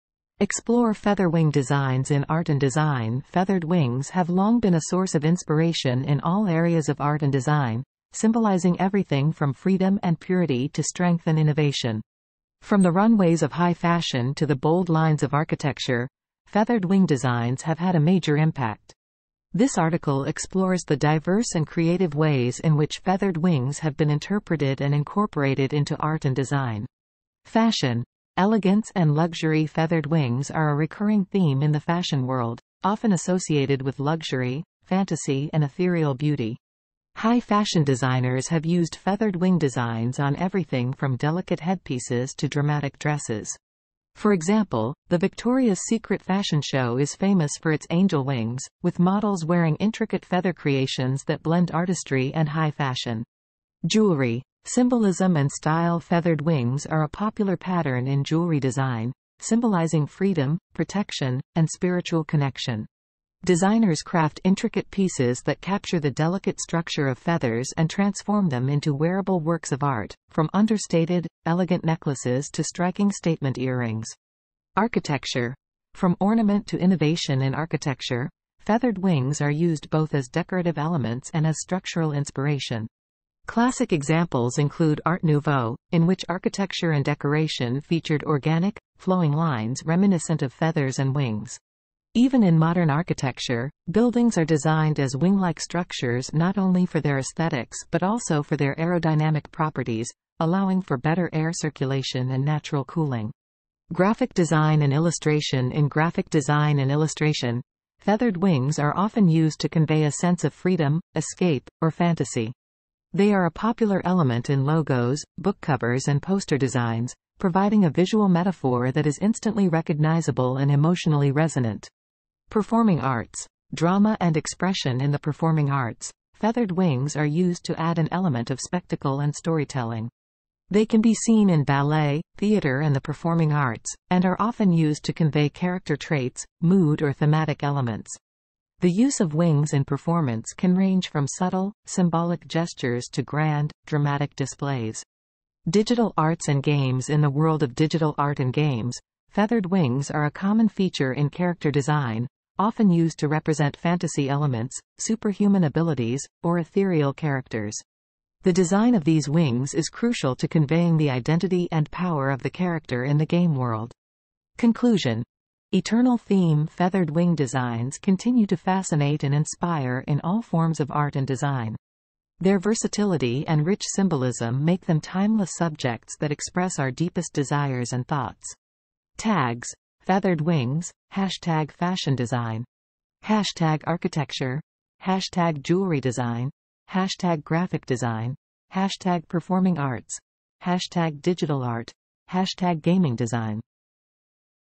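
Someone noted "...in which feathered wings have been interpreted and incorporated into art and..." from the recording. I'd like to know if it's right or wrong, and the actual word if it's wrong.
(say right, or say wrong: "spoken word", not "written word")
right.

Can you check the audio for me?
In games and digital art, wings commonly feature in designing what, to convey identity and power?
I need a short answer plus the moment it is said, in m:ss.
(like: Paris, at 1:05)
Character design, at 2:31.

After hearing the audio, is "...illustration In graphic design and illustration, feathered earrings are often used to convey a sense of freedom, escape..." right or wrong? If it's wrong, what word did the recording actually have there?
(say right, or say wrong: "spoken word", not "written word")
wrong: "wings", not "earrings".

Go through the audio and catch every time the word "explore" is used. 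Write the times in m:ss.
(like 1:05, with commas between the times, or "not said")
0:00, 0:20.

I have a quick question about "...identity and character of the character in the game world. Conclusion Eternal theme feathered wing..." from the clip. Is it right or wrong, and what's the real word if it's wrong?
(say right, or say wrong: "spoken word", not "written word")
wrong: "power", not "character".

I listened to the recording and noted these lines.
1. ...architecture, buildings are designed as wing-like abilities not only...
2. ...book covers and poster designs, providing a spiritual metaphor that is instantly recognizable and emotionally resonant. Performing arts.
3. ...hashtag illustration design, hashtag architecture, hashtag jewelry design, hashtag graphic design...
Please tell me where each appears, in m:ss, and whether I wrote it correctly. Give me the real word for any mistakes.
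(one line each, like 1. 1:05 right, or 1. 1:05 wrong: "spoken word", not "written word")
1. 1:32 wrong: "structures", not "abilities"
2. 1:55 wrong: "visual", not "spiritual"
3. 3:01 wrong: "fashion", not "illustration".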